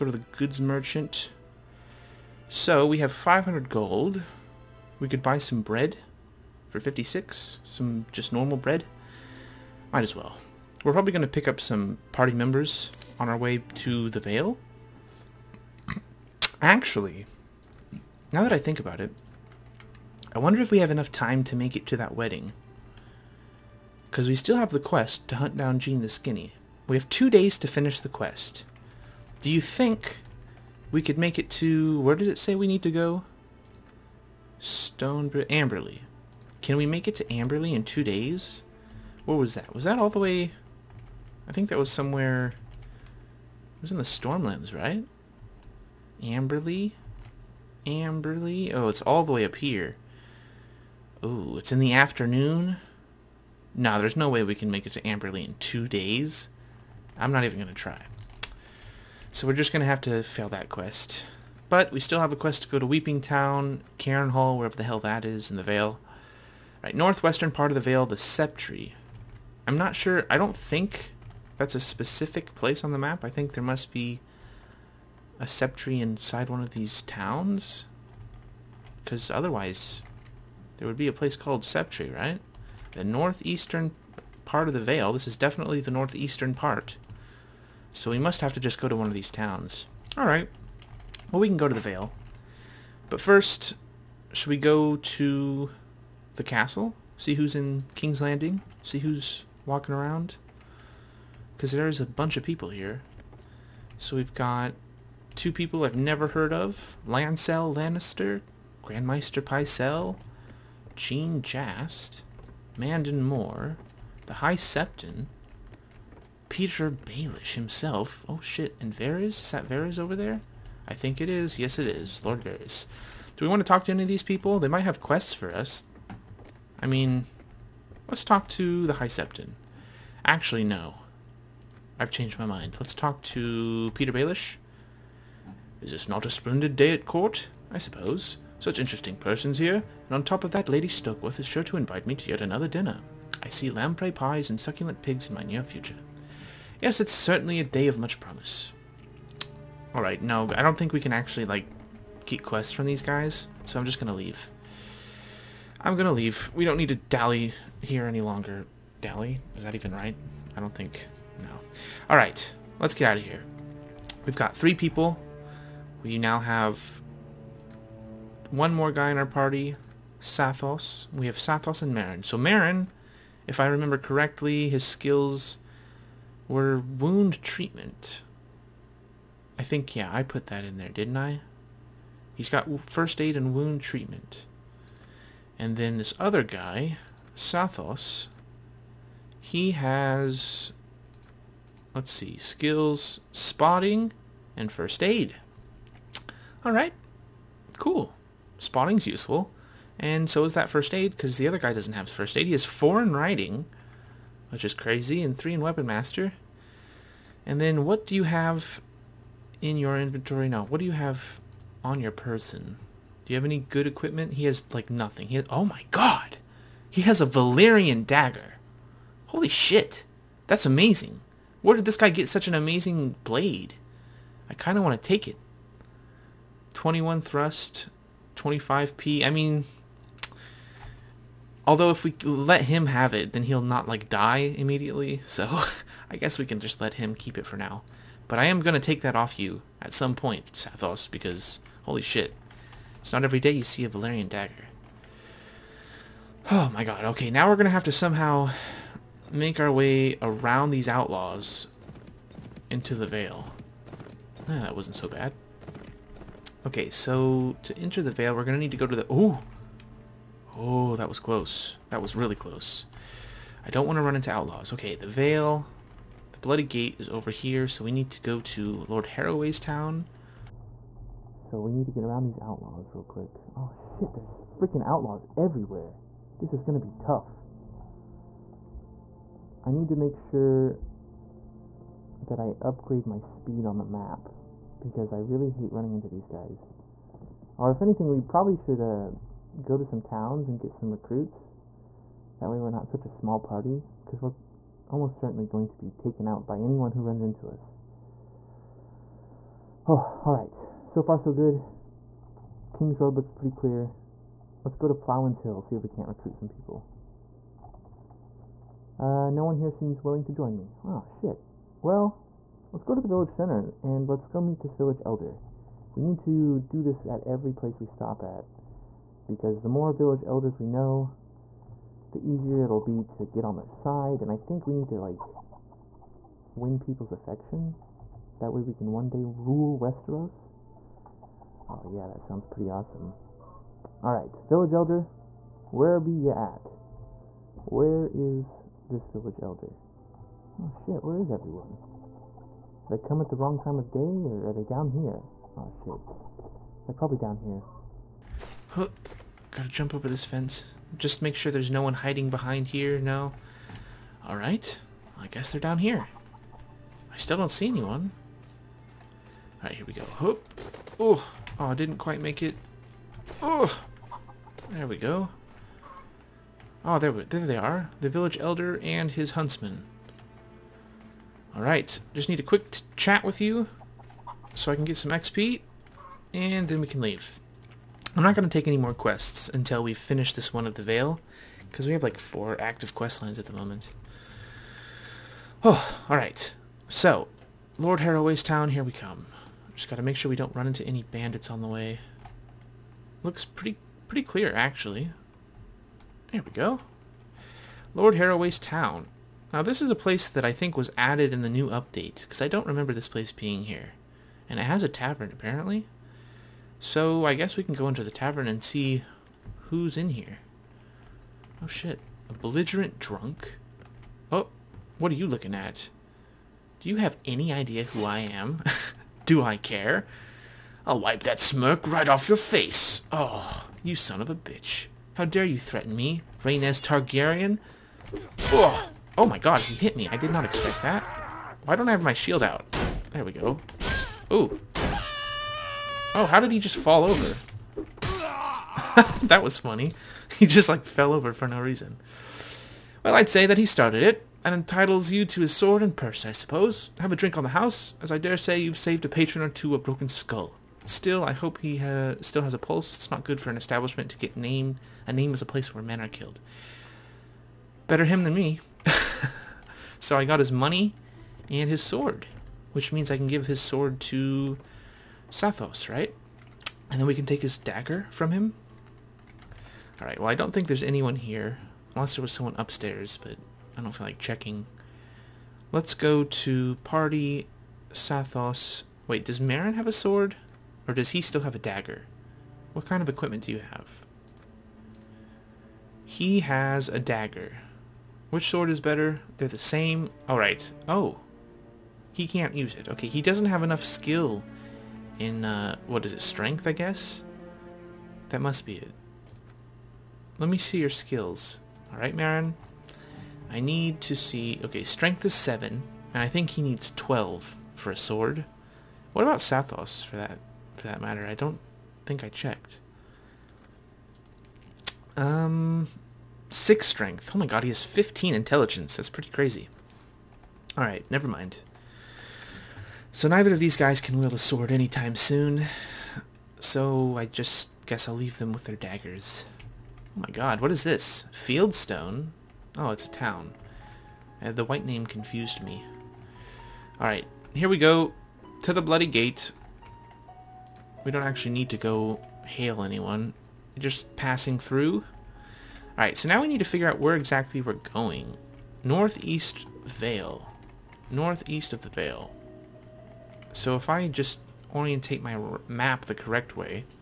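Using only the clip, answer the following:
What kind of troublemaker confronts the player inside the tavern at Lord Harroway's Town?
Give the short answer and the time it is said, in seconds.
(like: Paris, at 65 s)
A belligerent drunk, at 412 s.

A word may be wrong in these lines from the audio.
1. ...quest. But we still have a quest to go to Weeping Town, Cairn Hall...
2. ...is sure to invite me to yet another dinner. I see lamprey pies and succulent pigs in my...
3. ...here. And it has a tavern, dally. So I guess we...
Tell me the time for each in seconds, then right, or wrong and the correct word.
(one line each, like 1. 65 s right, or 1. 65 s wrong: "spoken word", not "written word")
1. 60 s right
2. 141 s right
3. 403 s wrong: "apparently", not "dally".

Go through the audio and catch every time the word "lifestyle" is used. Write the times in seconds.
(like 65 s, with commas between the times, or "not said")
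not said.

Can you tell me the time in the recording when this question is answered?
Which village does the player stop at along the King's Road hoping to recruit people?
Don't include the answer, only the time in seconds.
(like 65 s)
304 s.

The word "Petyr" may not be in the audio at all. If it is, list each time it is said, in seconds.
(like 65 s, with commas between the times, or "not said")
116 s, 133 s.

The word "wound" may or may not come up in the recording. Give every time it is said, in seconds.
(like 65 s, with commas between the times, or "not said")
176 s, 183 s.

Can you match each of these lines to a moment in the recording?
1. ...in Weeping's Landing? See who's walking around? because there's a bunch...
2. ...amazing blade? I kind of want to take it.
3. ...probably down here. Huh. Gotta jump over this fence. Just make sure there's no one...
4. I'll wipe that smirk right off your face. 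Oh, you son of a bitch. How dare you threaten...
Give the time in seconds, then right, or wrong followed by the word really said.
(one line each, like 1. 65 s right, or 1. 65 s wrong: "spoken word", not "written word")
1. 97 s wrong: "King", not "Weeping"
2. 222 s right
3. 346 s right
4. 420 s right.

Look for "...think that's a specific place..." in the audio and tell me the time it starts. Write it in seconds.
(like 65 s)
70 s.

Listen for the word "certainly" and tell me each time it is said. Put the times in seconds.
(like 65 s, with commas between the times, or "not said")
147 s, 295 s.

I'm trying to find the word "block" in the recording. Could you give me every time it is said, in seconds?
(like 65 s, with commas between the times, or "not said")
not said.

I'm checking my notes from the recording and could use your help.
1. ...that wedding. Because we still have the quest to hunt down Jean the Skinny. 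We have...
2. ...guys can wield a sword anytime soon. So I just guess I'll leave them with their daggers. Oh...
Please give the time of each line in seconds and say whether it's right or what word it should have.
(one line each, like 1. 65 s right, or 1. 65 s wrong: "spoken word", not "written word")
1. 21 s right
2. 523 s right.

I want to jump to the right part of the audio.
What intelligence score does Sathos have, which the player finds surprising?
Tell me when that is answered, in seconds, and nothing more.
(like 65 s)
517 s.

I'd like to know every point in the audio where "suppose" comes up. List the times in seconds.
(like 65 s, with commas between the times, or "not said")
137 s, 446 s.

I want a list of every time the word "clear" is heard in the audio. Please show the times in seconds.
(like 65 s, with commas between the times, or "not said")
303 s, 394 s.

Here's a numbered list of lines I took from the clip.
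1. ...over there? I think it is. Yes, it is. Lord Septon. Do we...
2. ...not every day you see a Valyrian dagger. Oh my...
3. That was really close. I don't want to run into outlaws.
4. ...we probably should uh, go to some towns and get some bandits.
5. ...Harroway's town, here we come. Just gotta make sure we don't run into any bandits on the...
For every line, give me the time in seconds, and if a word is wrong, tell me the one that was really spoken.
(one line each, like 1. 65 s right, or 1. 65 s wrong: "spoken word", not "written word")
1. 119 s wrong: "Varys", not "Septon"
2. 243 s right
3. 261 s right
4. 288 s wrong: "recruits", not "bandits"
5. 387 s right.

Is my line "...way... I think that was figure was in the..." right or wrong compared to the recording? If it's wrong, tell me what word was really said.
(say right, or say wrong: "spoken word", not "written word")
wrong: "somewhere", not "figure".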